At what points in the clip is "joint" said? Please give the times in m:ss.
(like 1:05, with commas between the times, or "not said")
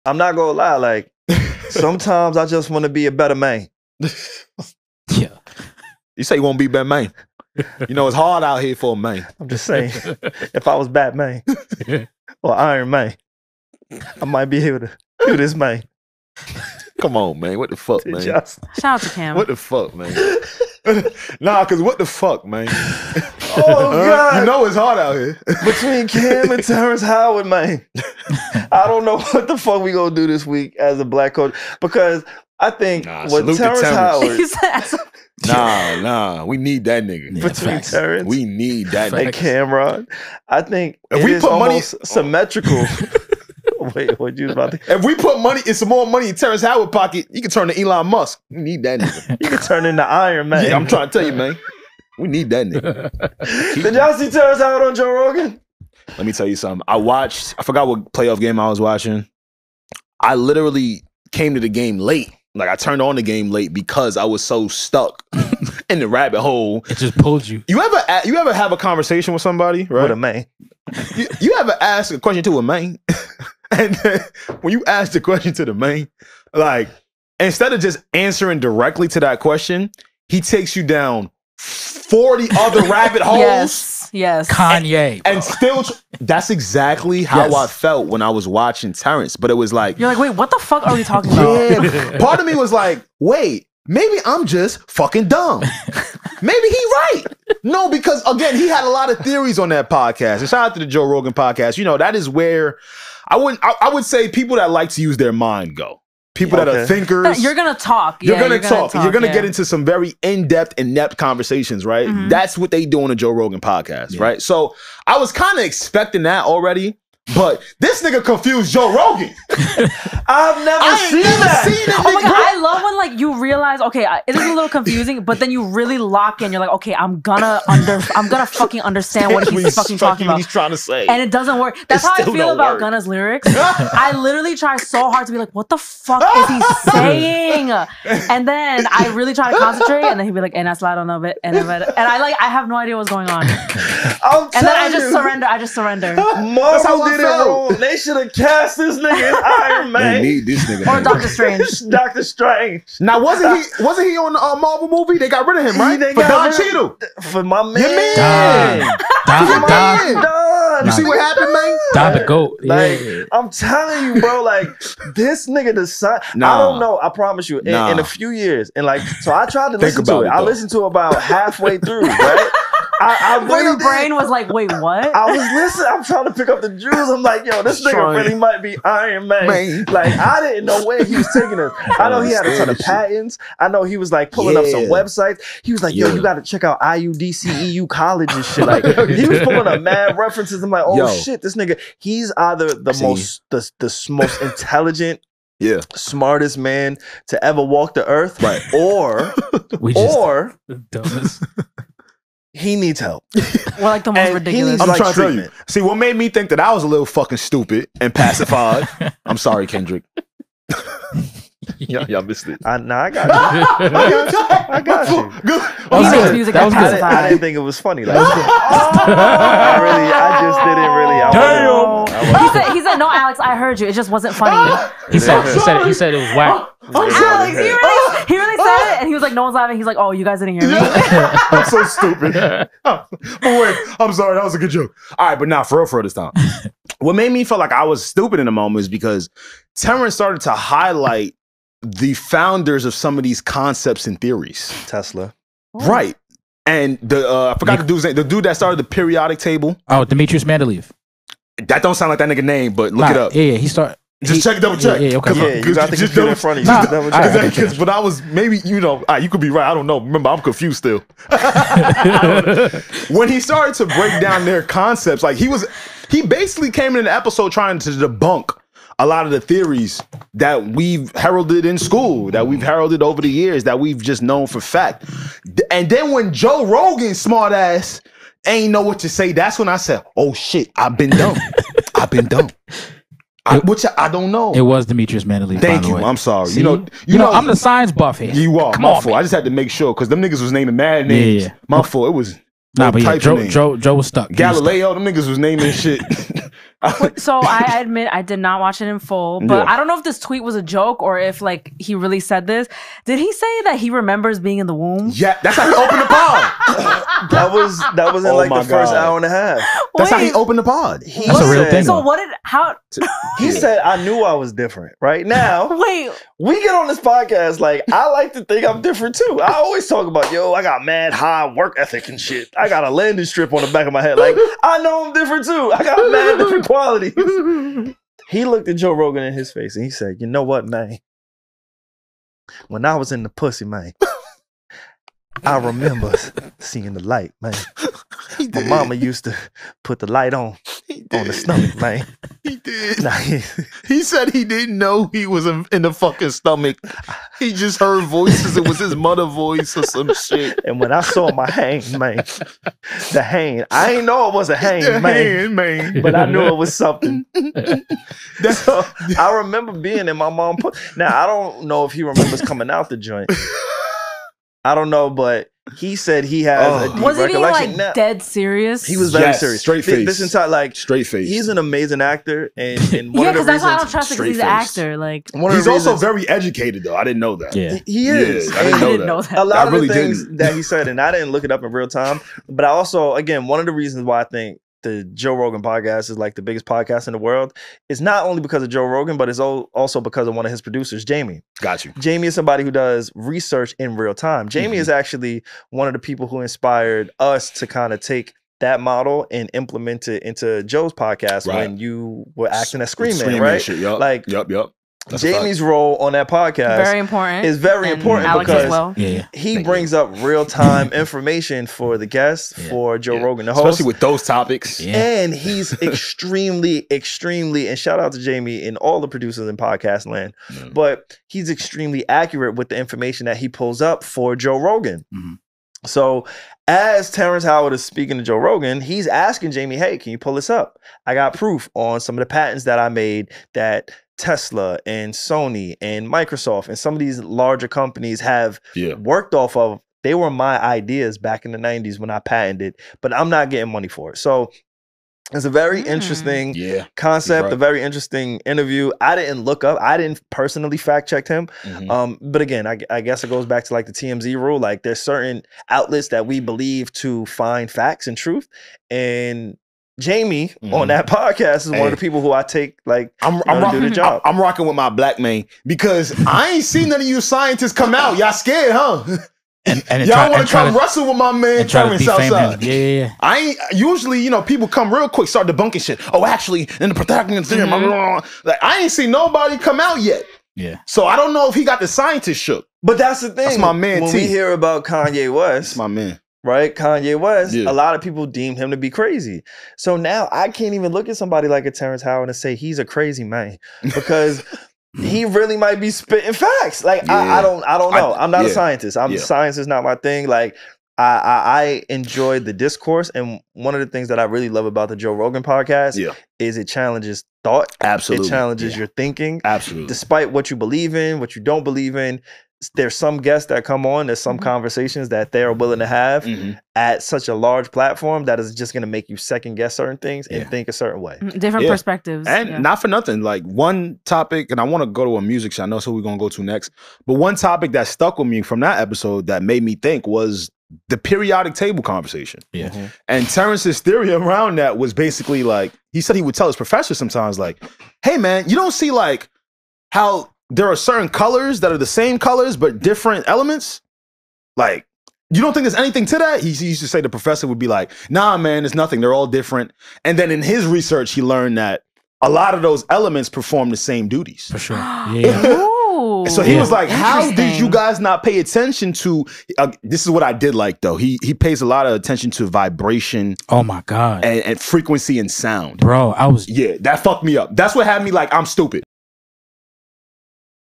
6:02.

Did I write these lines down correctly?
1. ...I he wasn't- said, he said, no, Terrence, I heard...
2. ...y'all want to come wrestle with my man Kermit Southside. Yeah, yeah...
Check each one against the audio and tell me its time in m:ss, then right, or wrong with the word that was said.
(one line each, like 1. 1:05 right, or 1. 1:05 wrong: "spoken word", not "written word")
1. 3:41 wrong: "Alex", not "Terrence"
2. 7:50 right.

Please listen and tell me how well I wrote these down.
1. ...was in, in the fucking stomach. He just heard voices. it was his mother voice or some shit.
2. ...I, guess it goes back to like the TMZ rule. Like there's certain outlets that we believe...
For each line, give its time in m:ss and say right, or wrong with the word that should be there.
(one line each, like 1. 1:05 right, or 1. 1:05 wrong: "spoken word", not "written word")
1. 5:45 right
2. 7:32 right.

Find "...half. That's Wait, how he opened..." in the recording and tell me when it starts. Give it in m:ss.
5:09.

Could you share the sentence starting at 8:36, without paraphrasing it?
at such a large platform that is just going to make you second guess certain things yeah.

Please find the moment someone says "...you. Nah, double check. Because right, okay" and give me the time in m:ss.
4:16.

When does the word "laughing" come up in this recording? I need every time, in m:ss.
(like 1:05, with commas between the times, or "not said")
3:49.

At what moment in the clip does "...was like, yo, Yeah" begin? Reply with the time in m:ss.
3:05.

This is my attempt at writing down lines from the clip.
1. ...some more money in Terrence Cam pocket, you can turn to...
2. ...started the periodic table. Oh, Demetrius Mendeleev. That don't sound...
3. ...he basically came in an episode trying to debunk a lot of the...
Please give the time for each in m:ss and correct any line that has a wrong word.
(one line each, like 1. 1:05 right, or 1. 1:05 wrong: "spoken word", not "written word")
1. 0:45 wrong: "Howard", not "Cam"
2. 4:08 right
3. 4:26 right.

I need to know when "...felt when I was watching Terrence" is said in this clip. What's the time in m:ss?
1:27.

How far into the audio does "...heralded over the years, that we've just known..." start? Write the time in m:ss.
4:32.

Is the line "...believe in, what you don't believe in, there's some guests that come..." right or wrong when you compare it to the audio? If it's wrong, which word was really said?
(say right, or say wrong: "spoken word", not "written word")
right.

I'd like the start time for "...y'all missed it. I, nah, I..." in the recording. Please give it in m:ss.
3:32.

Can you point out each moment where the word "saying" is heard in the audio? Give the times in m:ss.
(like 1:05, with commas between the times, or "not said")
0:09, 2:16.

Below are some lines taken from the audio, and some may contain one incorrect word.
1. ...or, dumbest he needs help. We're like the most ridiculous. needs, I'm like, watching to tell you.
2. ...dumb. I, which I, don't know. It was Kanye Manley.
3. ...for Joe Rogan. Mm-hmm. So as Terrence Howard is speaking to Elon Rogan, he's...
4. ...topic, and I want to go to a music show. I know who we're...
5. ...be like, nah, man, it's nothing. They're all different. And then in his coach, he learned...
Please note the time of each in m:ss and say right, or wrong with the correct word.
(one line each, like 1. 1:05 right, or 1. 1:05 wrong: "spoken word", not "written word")
1. 3:20 wrong: "trying", not "watching"
2. 4:42 wrong: "Demetrius", not "Kanye"
3. 7:04 wrong: "Joe", not "Elon"
4. 8:44 right
5. 9:07 wrong: "research", not "coach".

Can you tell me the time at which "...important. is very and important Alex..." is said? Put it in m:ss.
6:46.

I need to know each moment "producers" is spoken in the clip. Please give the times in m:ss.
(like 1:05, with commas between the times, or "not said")
6:30, 6:59.